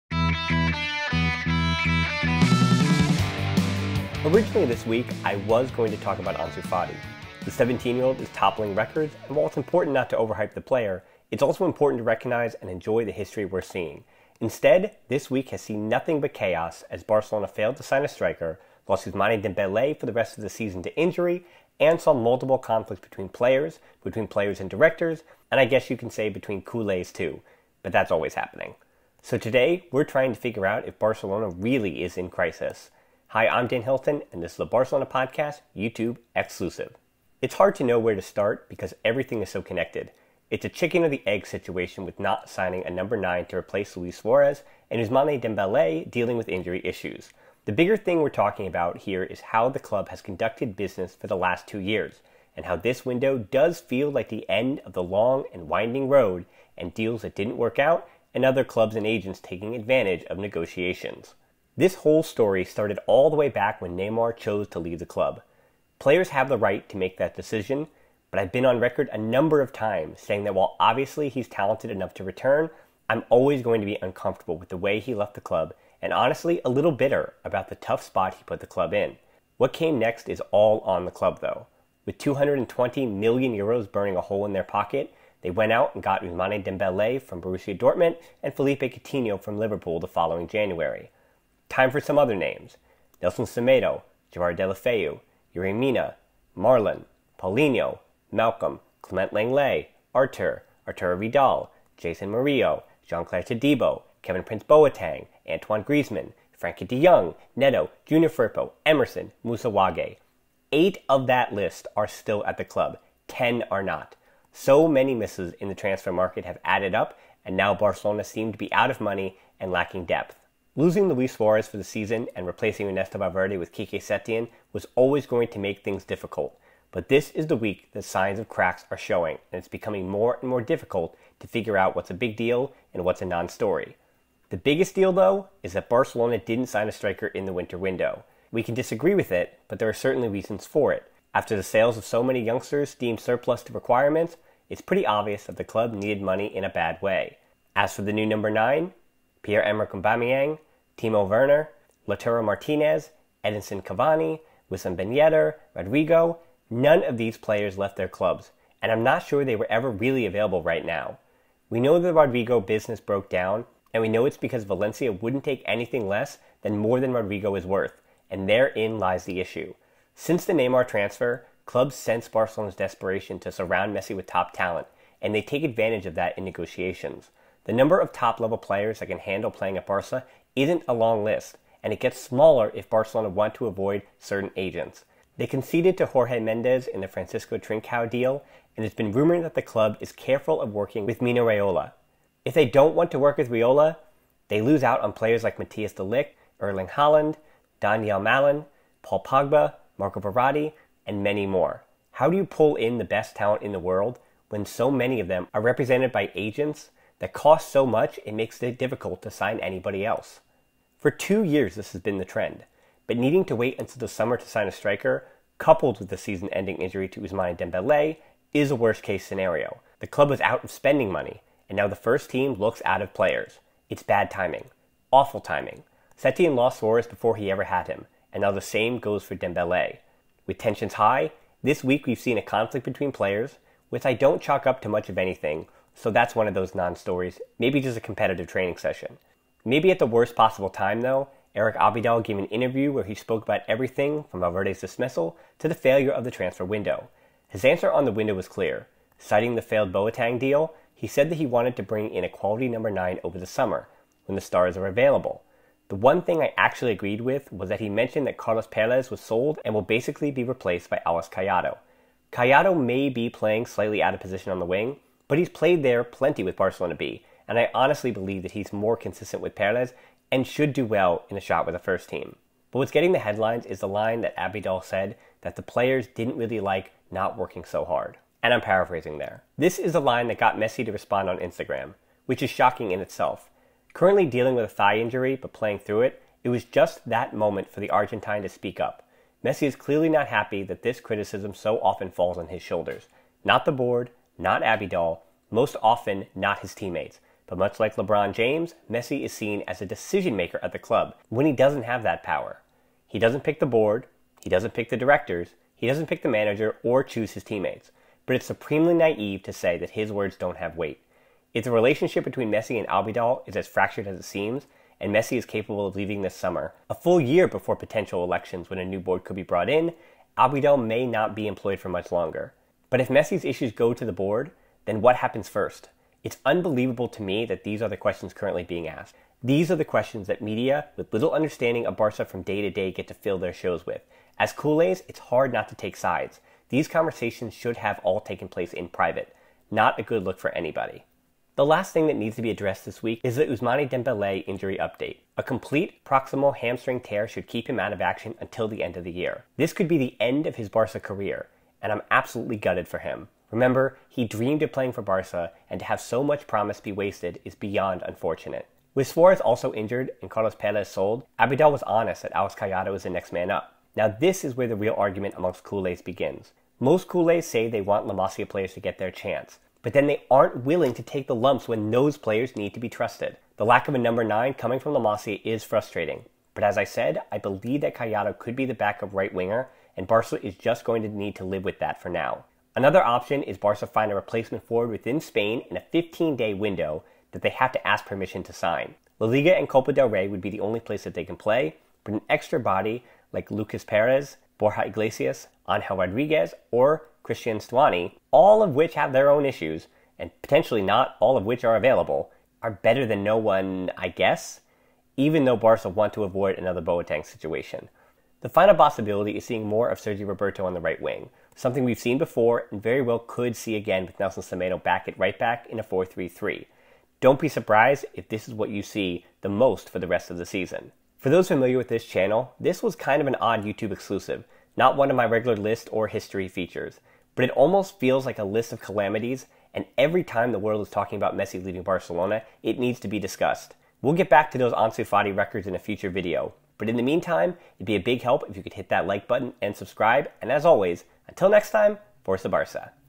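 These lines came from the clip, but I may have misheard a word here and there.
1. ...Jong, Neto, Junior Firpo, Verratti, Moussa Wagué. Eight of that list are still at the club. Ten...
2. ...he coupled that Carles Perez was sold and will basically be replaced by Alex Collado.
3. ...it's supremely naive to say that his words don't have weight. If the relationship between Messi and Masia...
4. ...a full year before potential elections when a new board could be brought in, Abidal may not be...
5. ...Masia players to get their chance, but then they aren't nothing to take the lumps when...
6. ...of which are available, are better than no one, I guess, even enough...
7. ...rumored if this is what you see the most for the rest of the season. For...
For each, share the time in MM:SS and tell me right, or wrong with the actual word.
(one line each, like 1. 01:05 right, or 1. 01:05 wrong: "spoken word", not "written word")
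1. 01:47 wrong: "Emerson", not "Verratti"
2. 04:17 wrong: "mentioned", not "coupled"
3. 05:08 wrong: "Abidal", not "Masia"
4. 05:16 right
5. 06:08 wrong: "willing", not "nothing"
6. 06:41 wrong: "though", not "enough"
7. 06:57 wrong: "surprised", not "rumored".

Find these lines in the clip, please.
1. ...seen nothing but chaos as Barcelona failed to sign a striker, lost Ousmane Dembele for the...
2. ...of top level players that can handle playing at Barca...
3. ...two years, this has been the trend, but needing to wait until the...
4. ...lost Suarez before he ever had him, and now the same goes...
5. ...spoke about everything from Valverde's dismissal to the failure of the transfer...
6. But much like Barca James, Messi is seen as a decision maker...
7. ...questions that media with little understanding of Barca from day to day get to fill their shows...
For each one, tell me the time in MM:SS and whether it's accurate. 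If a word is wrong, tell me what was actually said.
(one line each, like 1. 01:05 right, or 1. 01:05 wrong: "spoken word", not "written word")
1. 00:15 right
2. 02:57 right
3. 03:31 right
4. 03:46 right
5. 04:03 right
6. 04:57 wrong: "LeBron", not "Barca"
7. 05:29 right.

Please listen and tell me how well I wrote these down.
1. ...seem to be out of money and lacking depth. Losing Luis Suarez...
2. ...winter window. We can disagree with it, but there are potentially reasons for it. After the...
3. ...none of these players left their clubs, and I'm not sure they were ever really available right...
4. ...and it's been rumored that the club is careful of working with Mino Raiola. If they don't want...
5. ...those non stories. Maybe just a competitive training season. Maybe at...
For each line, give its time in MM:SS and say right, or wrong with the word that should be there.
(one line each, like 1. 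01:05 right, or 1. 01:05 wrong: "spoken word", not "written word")
1. 01:58 right
2. 02:17 wrong: "certainly", not "potentially"
3. 02:36 right
4. 03:08 right
5. 03:56 wrong: "session", not "season".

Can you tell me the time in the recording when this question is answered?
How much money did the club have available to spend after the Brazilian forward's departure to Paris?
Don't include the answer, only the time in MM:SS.
01:22.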